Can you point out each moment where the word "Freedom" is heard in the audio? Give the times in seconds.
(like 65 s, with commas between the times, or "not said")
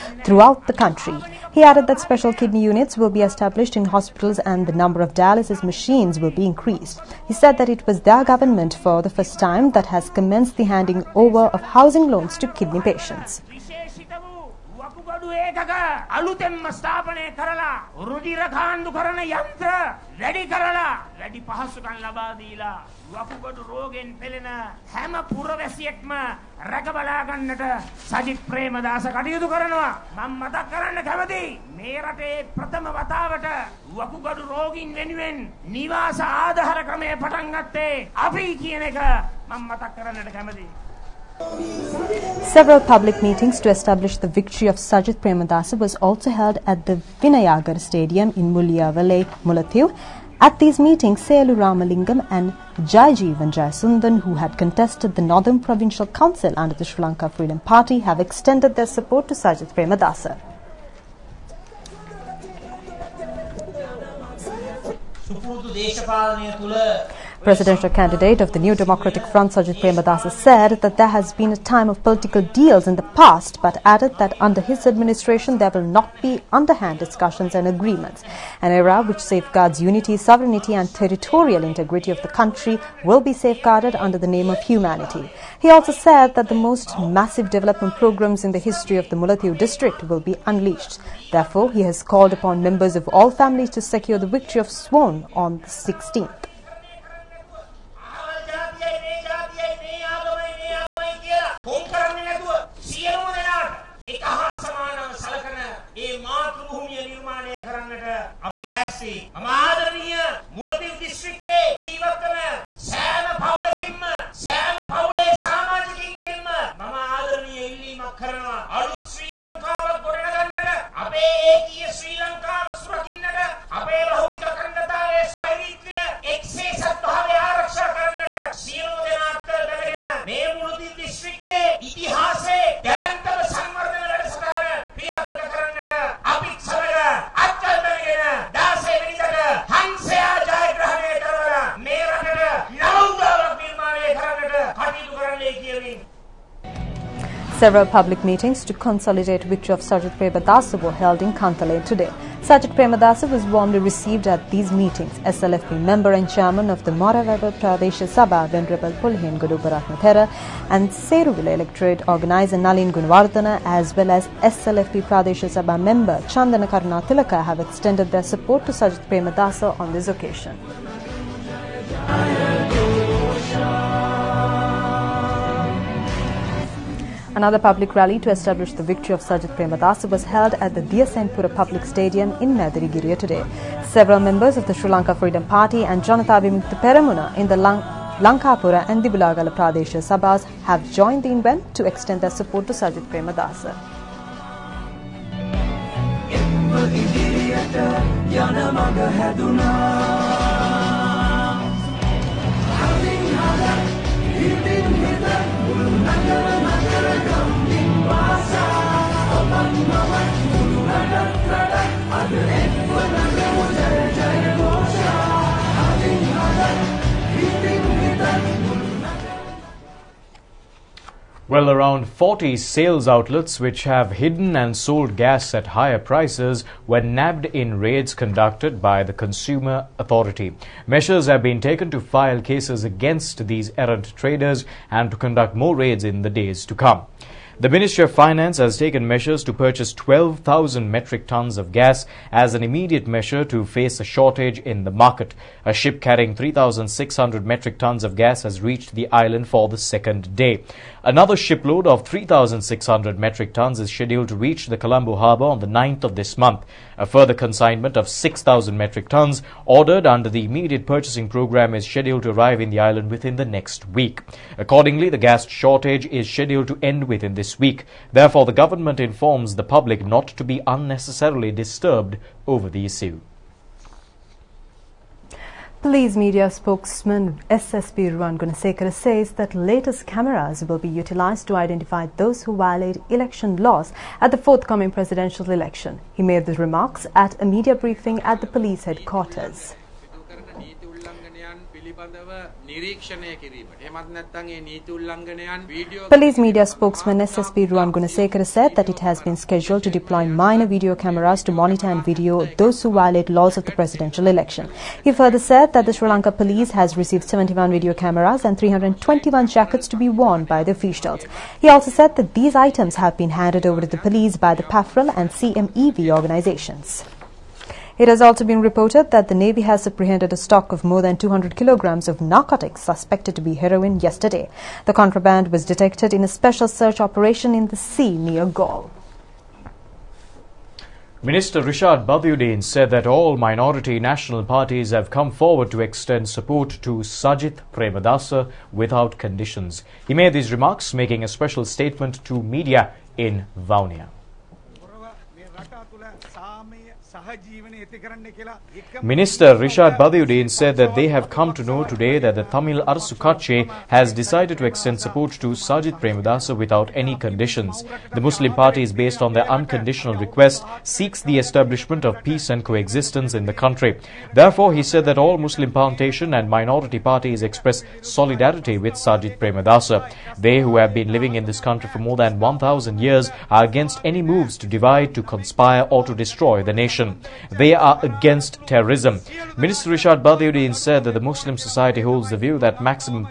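57 s, 185 s.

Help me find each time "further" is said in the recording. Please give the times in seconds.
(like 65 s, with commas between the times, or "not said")
257 s, 305 s.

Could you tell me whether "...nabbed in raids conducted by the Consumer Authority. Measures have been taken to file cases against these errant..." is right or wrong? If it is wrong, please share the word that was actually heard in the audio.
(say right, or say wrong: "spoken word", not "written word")
right.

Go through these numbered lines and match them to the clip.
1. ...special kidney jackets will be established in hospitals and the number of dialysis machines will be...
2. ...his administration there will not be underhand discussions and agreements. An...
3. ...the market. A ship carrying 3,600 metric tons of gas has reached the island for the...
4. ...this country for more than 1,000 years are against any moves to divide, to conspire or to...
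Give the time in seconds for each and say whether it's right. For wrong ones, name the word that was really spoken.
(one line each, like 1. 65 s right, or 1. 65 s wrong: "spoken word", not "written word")
1. 1 s wrong: "units", not "jackets"
2. 74 s right
3. 244 s right
4. 371 s right.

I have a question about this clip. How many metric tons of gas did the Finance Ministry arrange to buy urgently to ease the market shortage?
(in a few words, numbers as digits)
12,000.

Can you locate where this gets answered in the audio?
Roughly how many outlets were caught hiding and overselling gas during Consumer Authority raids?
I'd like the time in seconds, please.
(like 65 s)
222 s.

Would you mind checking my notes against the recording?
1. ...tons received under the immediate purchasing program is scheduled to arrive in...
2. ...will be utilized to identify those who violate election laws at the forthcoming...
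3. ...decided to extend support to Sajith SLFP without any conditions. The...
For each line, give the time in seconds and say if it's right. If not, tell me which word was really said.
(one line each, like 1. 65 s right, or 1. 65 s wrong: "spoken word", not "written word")
1. 259 s wrong: "ordered", not "received"
2. 280 s right
3. 354 s wrong: "Premadasa", not "SLFP".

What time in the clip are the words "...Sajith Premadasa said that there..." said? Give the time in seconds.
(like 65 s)
69 s.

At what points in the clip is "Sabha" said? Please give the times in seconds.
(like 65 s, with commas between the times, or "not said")
158 s, 165 s, 190 s.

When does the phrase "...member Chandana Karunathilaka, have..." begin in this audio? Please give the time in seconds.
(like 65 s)
165 s.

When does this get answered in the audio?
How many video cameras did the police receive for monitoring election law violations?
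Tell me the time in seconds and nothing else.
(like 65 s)
307 s.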